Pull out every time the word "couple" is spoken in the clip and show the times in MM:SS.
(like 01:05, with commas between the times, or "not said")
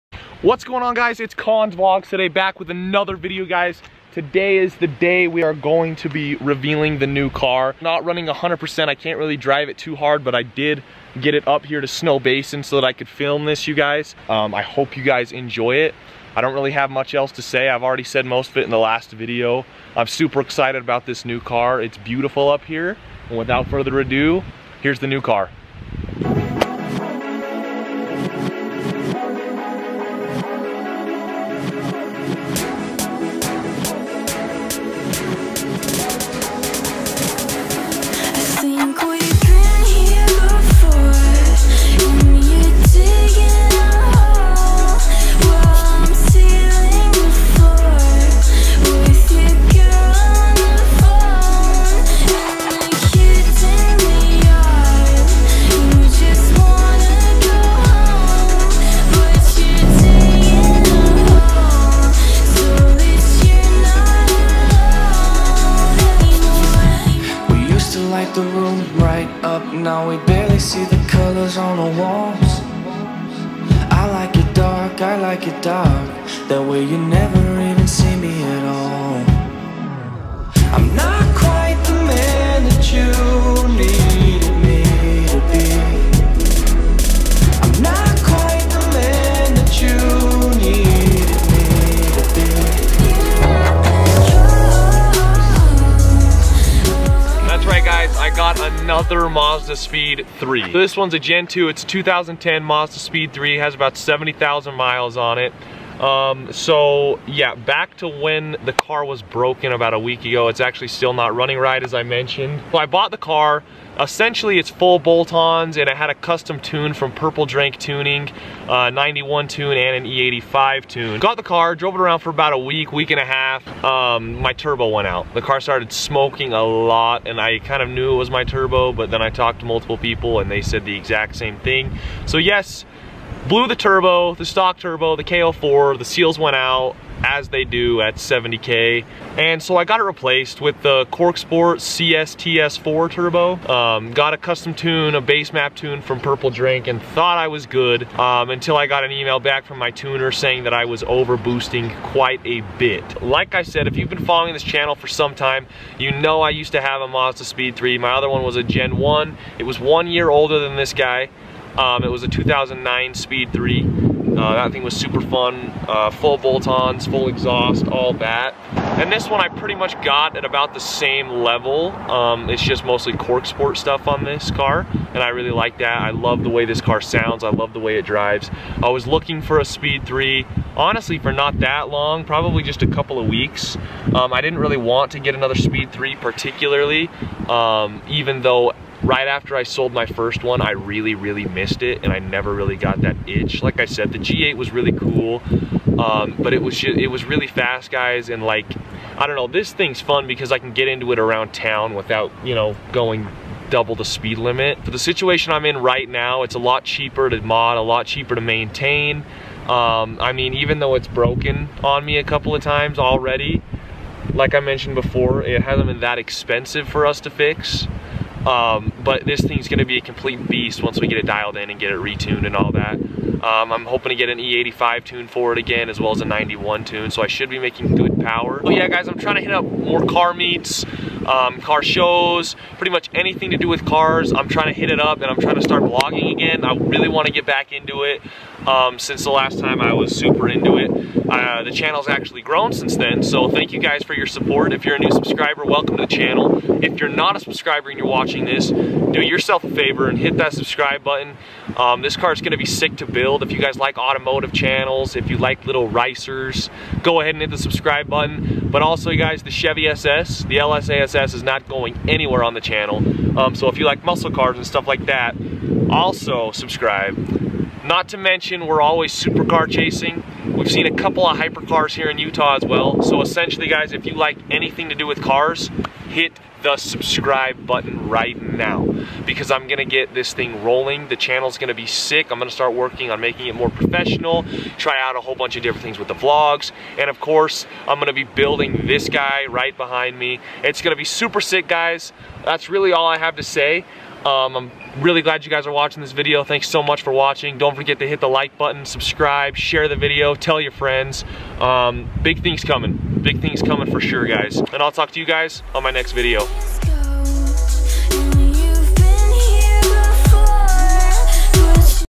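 03:02, 03:32, 04:30.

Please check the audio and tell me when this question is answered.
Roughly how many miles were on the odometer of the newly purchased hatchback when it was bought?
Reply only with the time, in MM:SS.
01:43.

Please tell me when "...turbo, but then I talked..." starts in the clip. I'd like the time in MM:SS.
02:08.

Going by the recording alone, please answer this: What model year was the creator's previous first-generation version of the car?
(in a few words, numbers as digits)
2009.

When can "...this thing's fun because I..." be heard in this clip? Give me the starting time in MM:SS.
03:19.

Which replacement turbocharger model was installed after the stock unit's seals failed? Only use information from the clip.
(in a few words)
Corksport CSTS4.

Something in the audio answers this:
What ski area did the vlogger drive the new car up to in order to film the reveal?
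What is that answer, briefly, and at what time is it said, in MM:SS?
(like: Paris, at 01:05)
Snowbasin, at 00:11.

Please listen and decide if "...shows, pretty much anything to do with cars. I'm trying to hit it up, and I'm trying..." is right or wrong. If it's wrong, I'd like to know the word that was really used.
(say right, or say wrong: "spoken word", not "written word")
right.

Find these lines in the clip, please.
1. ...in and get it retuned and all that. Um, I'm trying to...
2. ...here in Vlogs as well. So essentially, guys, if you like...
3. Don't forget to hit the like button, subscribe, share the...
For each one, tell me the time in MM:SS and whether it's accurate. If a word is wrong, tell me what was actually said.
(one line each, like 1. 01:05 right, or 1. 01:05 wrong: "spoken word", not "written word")
1. 03:41 wrong: "hoping", not "trying"
2. 04:31 wrong: "Utah", not "Vlogs"
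3. 04:57 right.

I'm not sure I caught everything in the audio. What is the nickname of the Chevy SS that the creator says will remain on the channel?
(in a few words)
LSASS.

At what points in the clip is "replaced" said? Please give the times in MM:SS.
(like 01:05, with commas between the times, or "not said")
02:20.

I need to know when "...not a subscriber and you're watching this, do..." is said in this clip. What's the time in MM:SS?
04:07.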